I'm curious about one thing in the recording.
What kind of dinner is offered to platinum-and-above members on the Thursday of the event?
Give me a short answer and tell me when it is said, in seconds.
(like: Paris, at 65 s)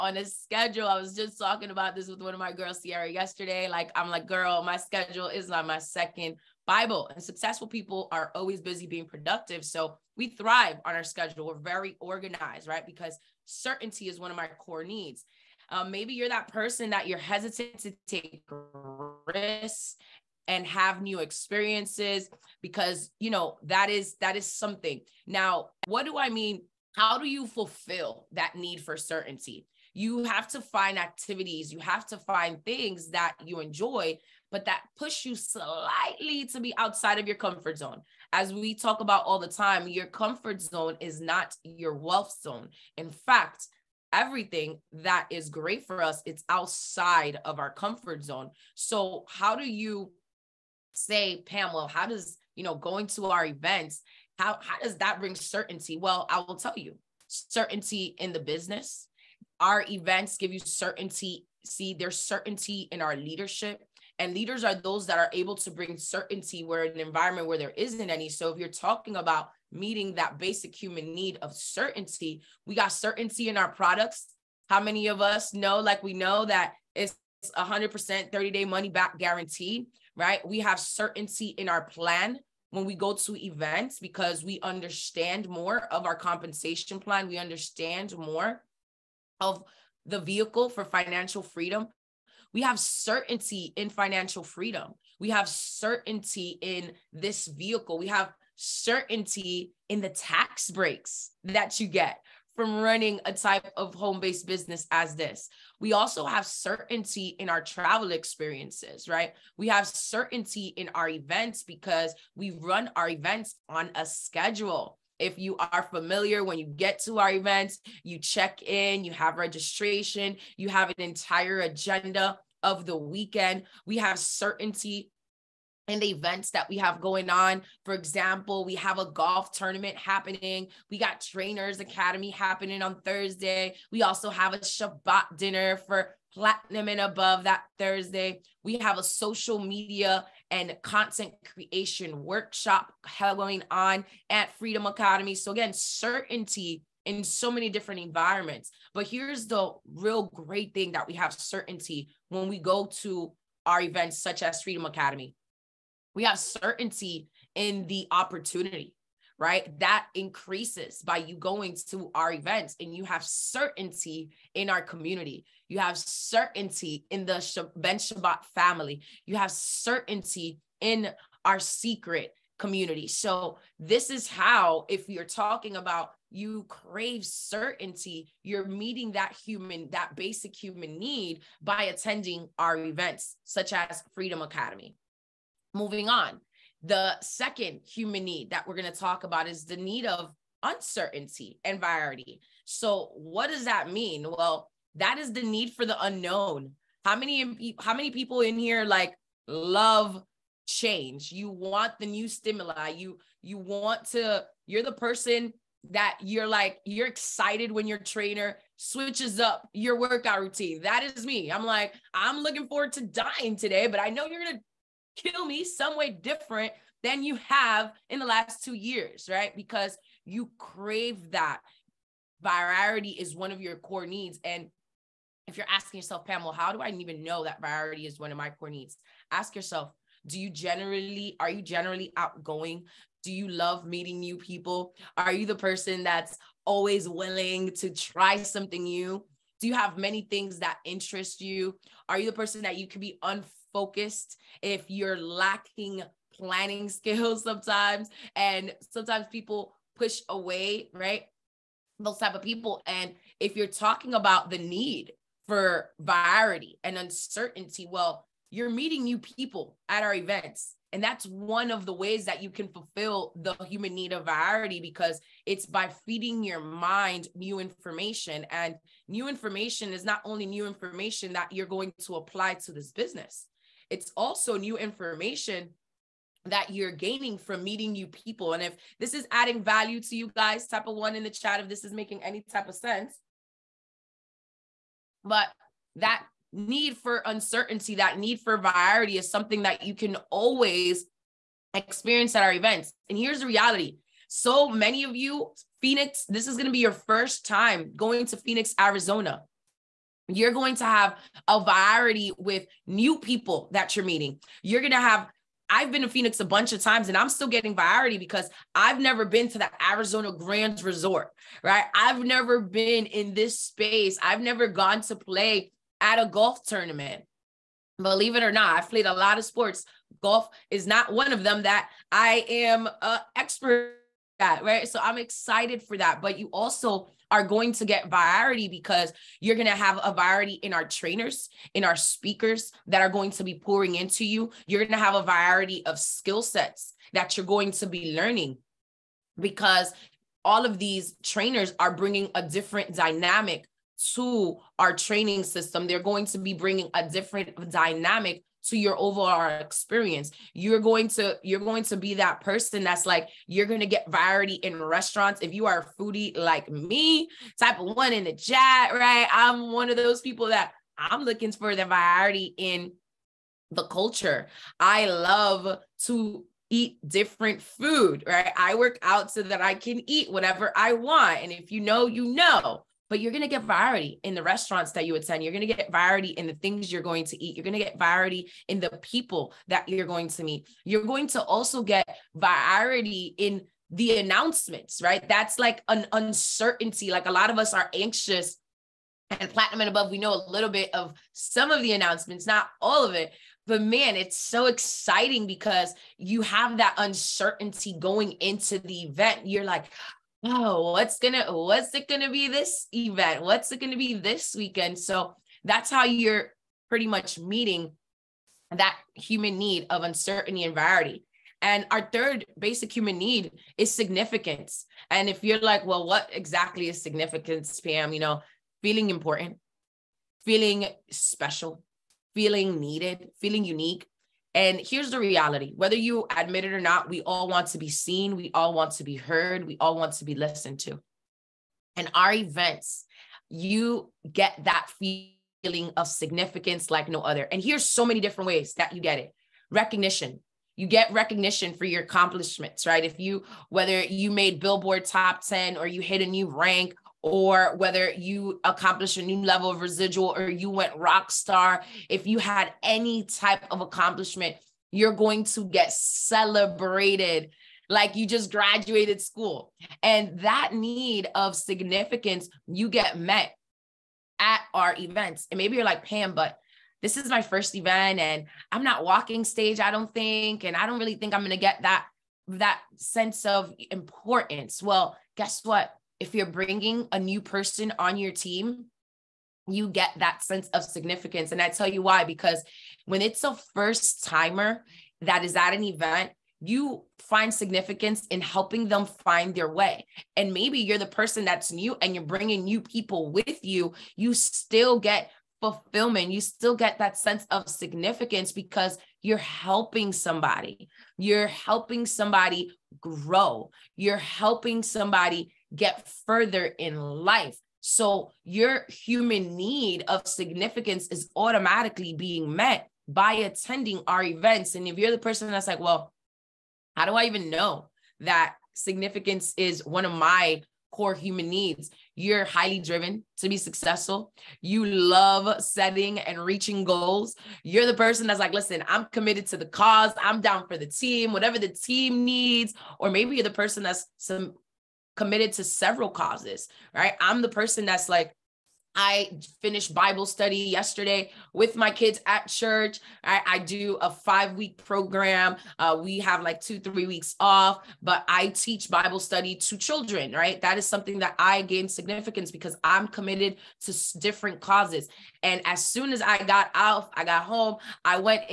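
Shabbat dinner, at 134 s.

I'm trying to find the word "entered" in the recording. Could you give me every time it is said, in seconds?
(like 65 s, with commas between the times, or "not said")
not said.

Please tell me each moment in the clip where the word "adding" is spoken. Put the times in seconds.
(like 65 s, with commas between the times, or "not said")
279 s.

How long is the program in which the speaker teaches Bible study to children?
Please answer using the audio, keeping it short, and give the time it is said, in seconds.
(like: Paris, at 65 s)
5 weeks, at 544 s.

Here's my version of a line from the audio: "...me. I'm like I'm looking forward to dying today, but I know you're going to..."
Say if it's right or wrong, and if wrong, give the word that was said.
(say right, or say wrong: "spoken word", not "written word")
right.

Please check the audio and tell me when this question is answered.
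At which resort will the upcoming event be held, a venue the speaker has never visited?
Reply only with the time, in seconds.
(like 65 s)
309 s.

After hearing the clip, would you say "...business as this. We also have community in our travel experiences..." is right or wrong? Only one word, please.
wrong.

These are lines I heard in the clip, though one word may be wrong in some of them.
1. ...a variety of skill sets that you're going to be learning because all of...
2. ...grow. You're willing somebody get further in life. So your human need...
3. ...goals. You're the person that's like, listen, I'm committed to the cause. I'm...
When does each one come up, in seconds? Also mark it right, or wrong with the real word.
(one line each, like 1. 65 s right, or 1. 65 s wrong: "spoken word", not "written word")
1. 335 s right
2. 503 s wrong: "helping", not "willing"
3. 526 s right.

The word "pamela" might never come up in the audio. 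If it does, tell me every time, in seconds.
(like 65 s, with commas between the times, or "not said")
51 s, 226 s.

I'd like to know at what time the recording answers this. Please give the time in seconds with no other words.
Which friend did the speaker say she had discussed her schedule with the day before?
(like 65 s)
2 s.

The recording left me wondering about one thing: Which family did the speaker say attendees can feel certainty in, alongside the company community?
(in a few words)
Ben Shabbat family.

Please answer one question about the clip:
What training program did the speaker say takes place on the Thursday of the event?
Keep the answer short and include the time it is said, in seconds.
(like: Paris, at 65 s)
Trainers Academy, at 131 s.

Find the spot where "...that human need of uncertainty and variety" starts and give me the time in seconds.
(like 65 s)
408 s.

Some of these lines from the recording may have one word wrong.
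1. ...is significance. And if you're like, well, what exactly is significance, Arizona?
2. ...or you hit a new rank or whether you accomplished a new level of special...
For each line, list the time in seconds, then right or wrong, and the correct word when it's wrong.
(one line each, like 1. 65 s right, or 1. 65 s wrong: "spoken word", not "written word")
1. 413 s wrong: "Pam", not "Arizona"
2. 445 s wrong: "residual", not "special".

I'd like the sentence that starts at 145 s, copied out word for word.
So, again, certainty in so many different environments.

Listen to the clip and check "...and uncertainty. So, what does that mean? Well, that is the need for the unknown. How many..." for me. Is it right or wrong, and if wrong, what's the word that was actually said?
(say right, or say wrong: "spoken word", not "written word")
wrong: "variety", not "uncertainty".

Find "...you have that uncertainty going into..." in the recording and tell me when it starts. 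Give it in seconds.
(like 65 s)
396 s.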